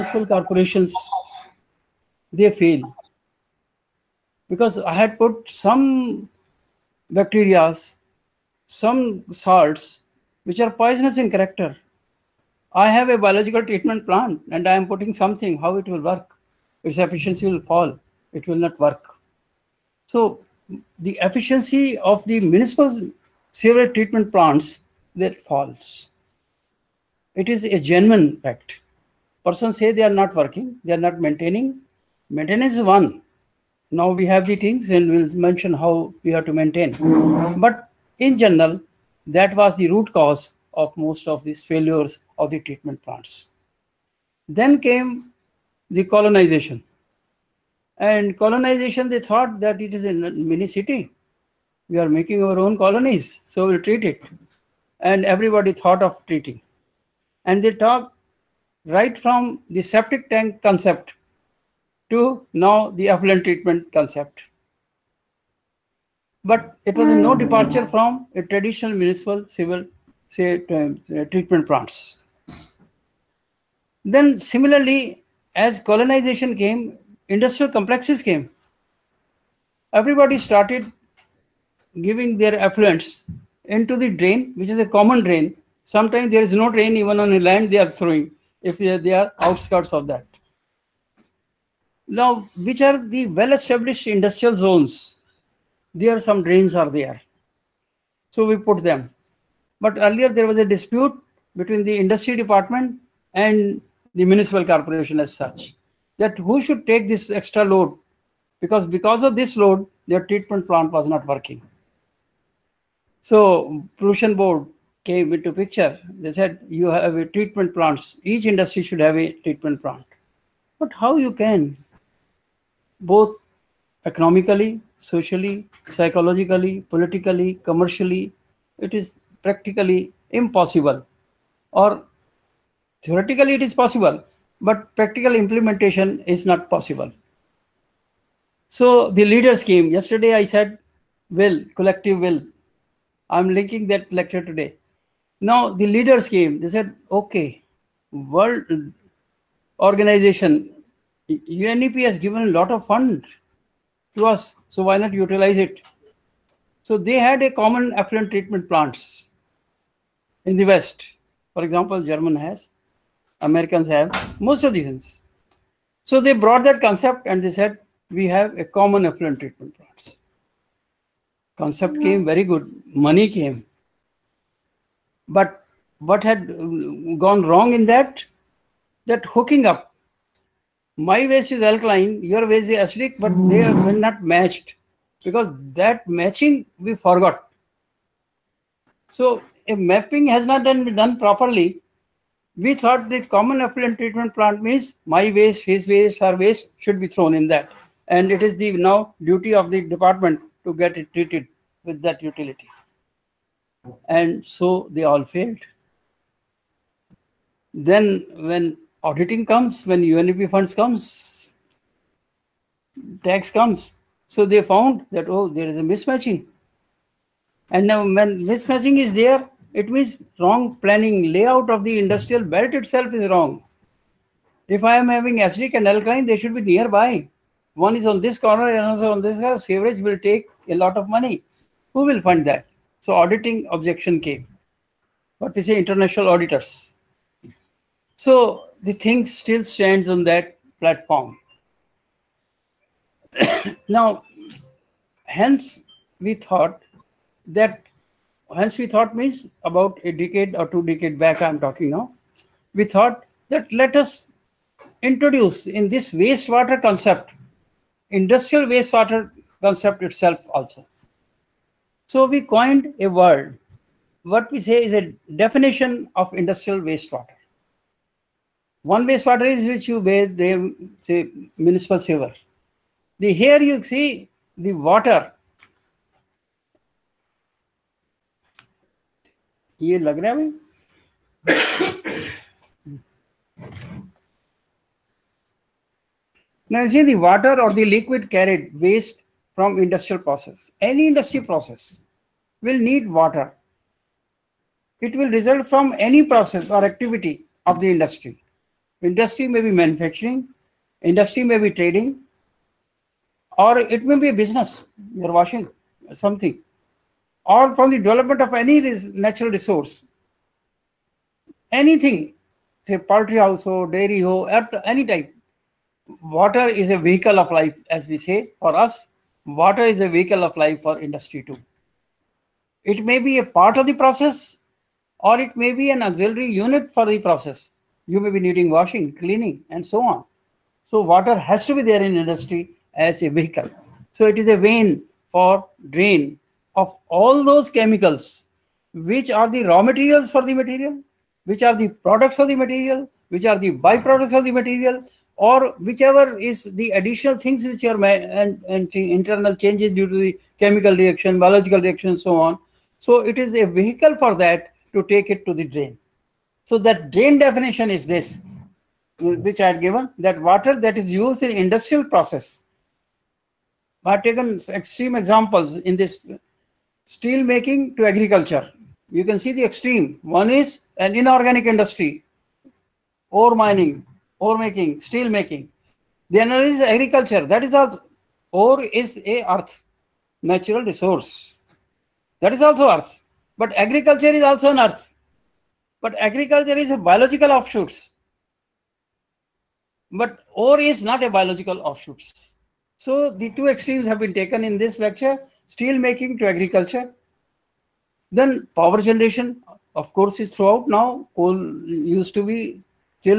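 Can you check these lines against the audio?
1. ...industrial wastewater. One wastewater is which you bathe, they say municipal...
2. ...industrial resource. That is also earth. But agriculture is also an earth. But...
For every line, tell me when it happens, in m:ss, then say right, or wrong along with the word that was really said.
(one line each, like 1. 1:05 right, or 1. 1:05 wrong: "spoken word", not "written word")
1. 4:26 right
2. 6:20 wrong: "natural", not "industrial".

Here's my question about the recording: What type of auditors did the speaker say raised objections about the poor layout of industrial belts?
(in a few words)
international auditors.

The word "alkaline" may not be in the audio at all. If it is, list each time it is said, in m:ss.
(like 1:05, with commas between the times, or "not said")
3:01, 3:45.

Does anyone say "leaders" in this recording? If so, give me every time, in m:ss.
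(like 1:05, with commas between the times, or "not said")
2:19, 2:25.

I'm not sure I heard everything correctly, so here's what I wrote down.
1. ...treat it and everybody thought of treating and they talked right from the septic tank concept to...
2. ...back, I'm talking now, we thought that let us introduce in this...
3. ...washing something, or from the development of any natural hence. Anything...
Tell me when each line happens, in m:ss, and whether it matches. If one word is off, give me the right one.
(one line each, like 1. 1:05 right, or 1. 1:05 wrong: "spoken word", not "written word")
1. 0:53 right
2. 4:11 right
3. 5:05 wrong: "resource", not "hence".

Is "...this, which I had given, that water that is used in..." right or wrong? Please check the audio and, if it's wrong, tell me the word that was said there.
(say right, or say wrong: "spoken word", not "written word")
right.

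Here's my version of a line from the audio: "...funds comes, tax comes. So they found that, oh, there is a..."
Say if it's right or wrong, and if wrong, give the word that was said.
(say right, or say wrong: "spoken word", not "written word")
right.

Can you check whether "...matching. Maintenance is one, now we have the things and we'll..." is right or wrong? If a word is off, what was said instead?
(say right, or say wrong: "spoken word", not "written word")
wrong: "maintaining", not "matching".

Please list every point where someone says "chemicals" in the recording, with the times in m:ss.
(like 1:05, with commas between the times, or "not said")
5:37, 5:50.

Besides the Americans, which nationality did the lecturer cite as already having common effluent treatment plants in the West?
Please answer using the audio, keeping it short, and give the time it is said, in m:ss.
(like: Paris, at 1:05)
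German, at 2:42.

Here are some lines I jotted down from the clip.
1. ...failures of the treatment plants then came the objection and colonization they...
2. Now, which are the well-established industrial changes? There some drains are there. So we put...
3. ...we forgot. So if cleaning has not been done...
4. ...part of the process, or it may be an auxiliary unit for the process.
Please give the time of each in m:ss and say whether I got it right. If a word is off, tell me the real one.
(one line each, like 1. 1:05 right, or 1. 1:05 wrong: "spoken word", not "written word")
1. 0:41 wrong: "colonization", not "objection"
2. 1:32 wrong: "zones", not "changes"
3. 3:06 wrong: "mapping", not "cleaning"
4. 5:23 right.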